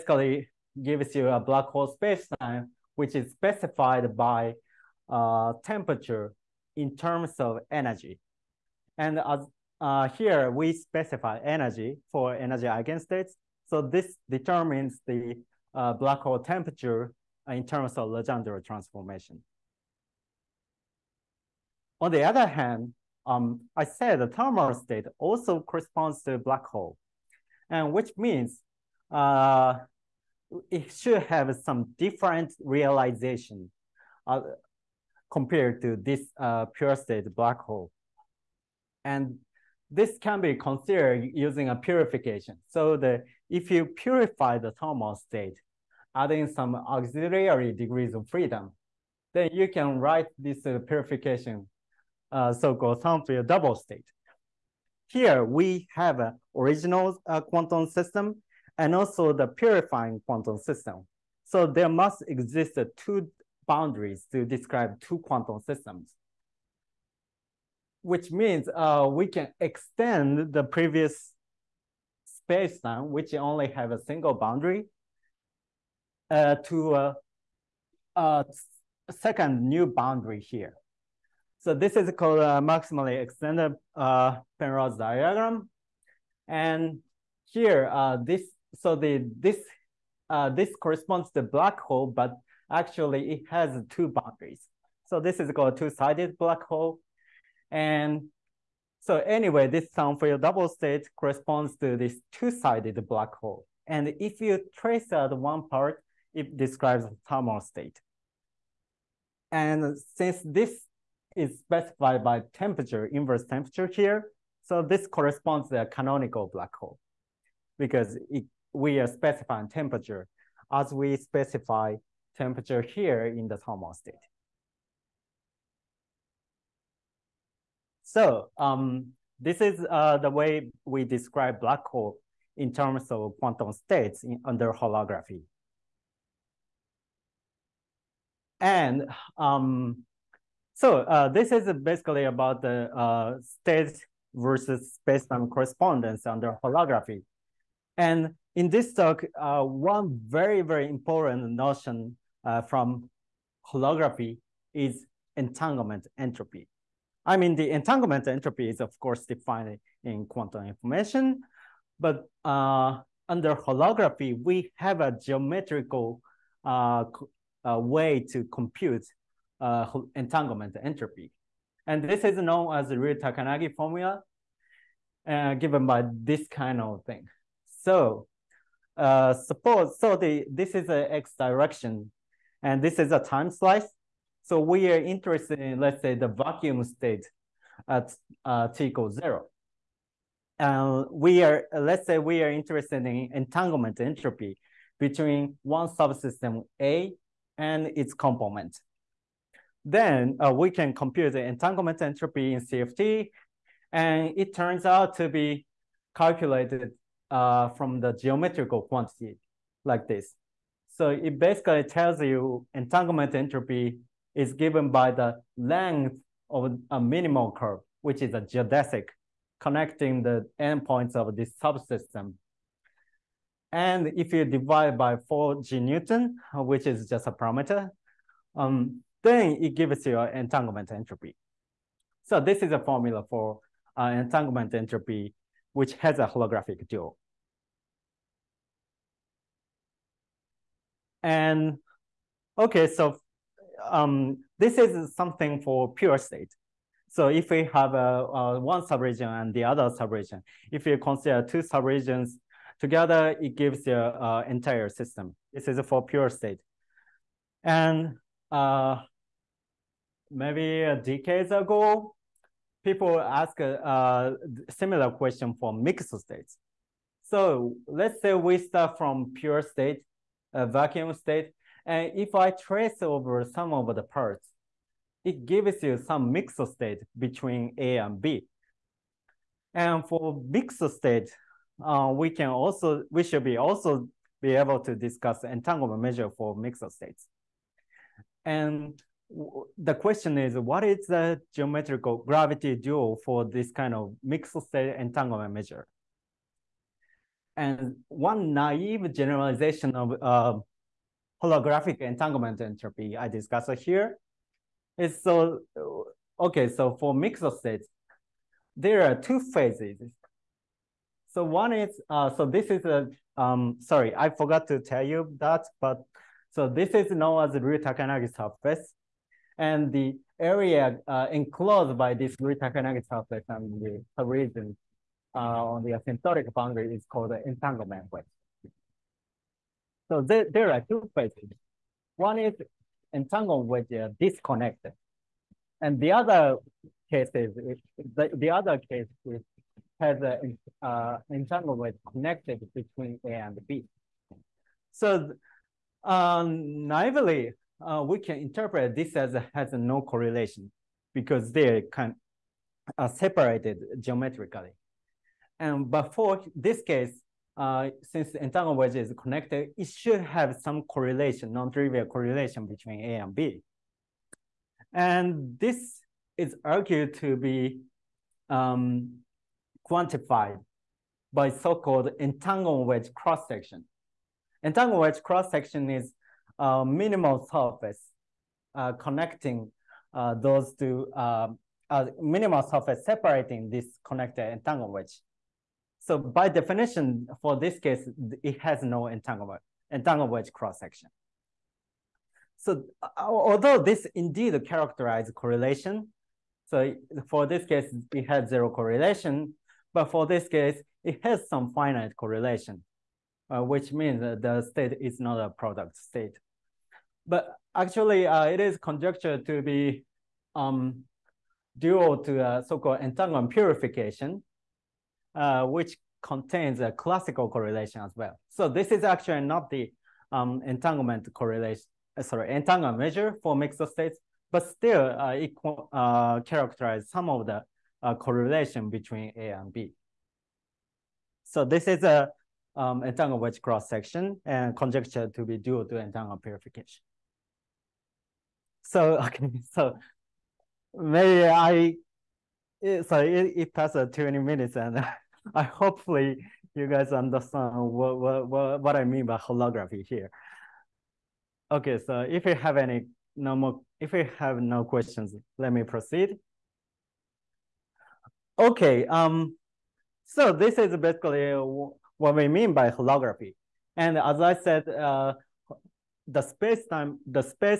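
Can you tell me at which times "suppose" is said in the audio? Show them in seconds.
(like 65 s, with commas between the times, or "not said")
179 s.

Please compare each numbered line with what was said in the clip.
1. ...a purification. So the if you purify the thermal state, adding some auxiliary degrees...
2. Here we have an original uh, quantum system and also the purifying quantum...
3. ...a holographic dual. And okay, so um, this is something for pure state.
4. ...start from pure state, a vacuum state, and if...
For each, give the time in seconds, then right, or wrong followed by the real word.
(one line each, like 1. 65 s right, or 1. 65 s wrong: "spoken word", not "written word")
1. 41 s right
2. 55 s right
3. 236 s right
4. 268 s right.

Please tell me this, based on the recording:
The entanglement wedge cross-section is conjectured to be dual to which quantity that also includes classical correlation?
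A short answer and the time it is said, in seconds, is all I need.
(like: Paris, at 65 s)
entanglement purification, at 413 s.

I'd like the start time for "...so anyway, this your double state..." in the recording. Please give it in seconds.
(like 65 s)
99 s.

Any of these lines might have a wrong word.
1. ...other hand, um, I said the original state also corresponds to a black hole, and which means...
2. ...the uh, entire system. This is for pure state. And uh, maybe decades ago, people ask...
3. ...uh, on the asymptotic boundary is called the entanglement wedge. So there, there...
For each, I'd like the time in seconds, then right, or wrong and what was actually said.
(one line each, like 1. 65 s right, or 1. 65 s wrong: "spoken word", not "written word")
1. 22 s wrong: "thermal", not "original"
2. 253 s right
3. 325 s right.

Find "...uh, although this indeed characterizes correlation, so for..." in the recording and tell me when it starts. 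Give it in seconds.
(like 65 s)
393 s.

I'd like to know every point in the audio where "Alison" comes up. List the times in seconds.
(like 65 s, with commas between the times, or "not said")
not said.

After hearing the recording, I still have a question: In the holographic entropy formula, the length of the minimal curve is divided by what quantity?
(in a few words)
4 G Newton.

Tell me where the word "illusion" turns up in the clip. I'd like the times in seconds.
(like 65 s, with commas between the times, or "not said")
not said.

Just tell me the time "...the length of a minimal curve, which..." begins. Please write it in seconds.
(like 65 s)
215 s.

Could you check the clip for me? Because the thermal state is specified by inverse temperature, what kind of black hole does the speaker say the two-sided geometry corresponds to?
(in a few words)
canonical black hole.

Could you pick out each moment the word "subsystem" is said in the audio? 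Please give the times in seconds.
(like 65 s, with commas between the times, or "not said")
195 s, 221 s.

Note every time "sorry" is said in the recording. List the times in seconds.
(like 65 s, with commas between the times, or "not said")
313 s, 422 s, 443 s.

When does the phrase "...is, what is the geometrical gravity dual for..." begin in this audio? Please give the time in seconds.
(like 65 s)
290 s.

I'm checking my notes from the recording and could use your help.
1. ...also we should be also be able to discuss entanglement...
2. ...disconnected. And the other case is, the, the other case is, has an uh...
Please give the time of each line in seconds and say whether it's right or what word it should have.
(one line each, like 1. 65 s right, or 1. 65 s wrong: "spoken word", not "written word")
1. 282 s right
2. 334 s right.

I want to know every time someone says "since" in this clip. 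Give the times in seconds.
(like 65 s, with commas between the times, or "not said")
110 s, 358 s.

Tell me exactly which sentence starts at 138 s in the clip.
And um, so uh, this is basically about the uh, state versus spacetime correspondence under holography.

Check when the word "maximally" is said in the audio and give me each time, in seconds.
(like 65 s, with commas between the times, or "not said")
82 s.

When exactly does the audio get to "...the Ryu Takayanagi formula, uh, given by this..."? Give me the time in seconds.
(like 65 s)
172 s.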